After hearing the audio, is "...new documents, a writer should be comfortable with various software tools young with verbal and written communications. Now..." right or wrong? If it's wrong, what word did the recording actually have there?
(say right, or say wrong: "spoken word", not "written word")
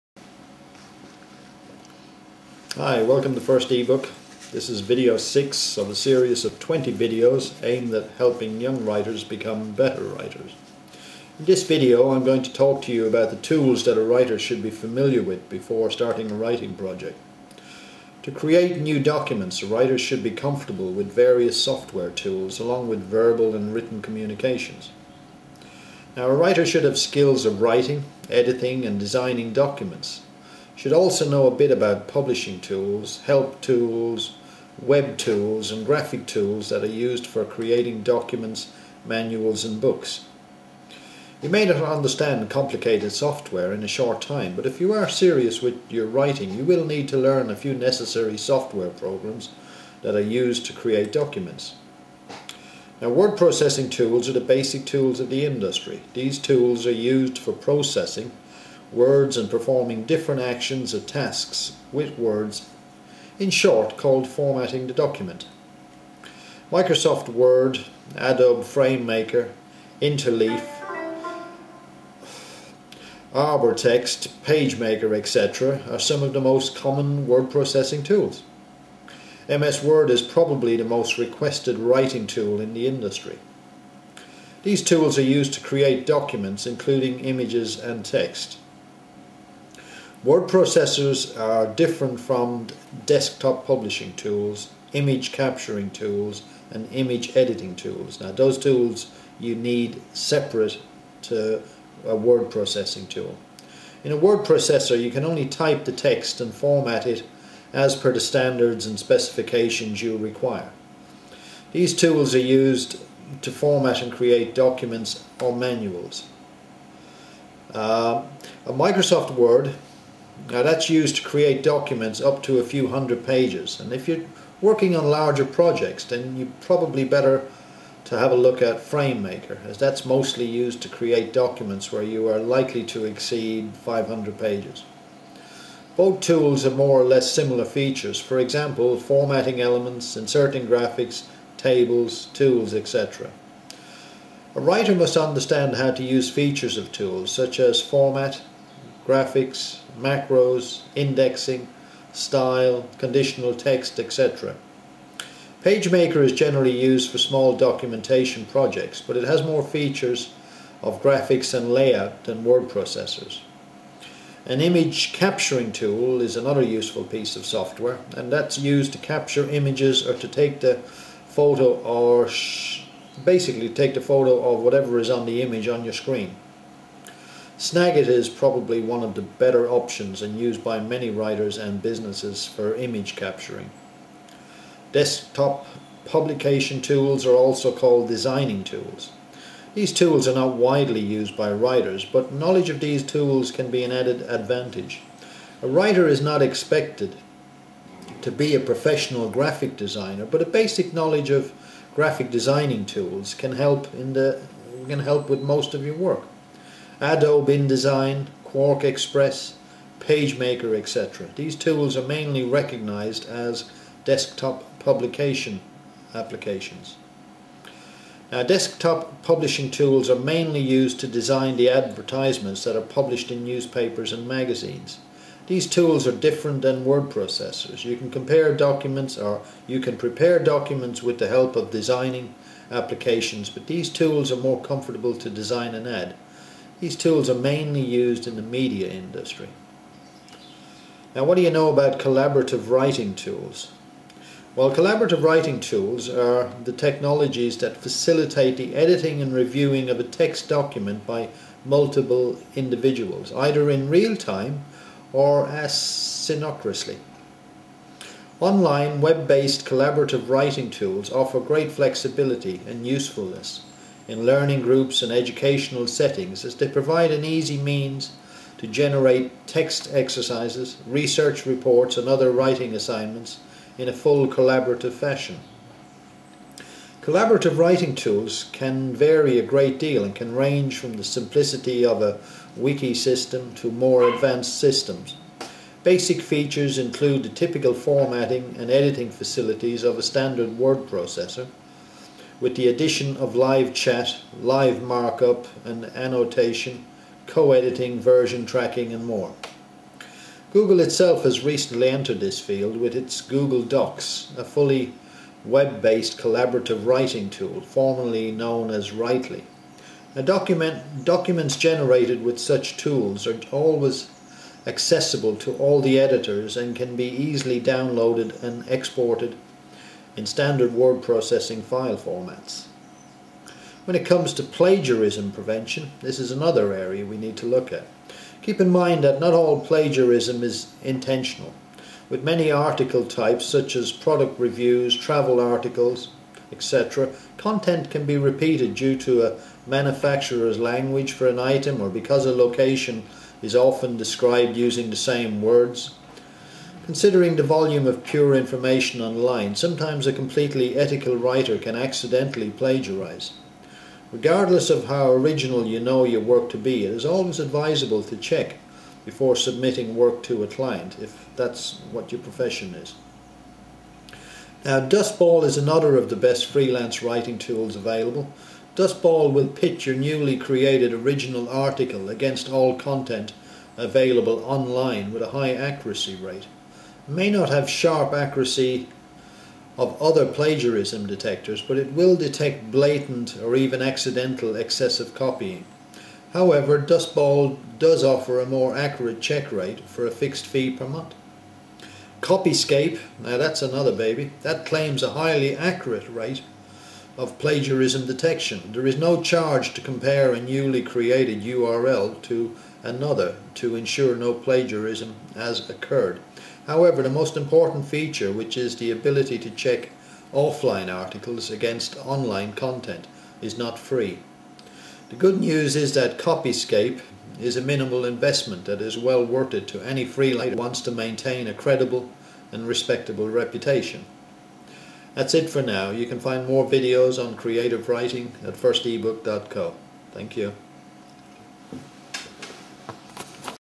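wrong: "along", not "young".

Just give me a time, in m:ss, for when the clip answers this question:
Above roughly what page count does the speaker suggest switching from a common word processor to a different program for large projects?
2:13.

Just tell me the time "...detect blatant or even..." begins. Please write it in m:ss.
6:22.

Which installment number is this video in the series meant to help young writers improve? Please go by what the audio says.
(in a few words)
6.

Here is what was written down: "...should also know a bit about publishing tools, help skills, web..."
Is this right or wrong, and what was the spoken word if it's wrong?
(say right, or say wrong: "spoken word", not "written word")
wrong: "tools", not "skills".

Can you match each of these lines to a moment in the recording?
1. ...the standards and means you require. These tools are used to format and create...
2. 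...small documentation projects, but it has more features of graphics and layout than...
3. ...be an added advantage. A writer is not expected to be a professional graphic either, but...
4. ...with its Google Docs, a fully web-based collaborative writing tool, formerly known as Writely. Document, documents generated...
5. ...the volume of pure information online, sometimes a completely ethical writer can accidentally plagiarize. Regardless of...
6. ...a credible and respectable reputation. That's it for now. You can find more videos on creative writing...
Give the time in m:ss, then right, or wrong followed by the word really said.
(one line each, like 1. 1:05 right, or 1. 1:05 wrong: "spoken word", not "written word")
1. 1:48 wrong: "specifications", not "means"
2. 2:37 right
3. 3:13 wrong: "designer", not "either"
4. 5:02 right
5. 5:47 right
6. 7:01 right.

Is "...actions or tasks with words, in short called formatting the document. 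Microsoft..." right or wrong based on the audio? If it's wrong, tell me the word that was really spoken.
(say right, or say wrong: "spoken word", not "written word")
right.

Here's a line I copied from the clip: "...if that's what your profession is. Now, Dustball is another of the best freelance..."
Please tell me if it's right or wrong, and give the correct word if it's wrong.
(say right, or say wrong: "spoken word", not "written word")
right.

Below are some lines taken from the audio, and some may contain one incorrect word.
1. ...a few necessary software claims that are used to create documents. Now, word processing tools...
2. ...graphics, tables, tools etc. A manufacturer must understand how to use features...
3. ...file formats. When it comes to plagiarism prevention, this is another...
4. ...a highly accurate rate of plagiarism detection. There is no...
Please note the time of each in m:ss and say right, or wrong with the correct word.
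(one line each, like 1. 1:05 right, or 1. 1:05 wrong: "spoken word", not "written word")
1. 0:47 wrong: "programs", not "claims"
2. 2:20 wrong: "writer", not "manufacturer"
3. 5:21 right
4. 6:35 right.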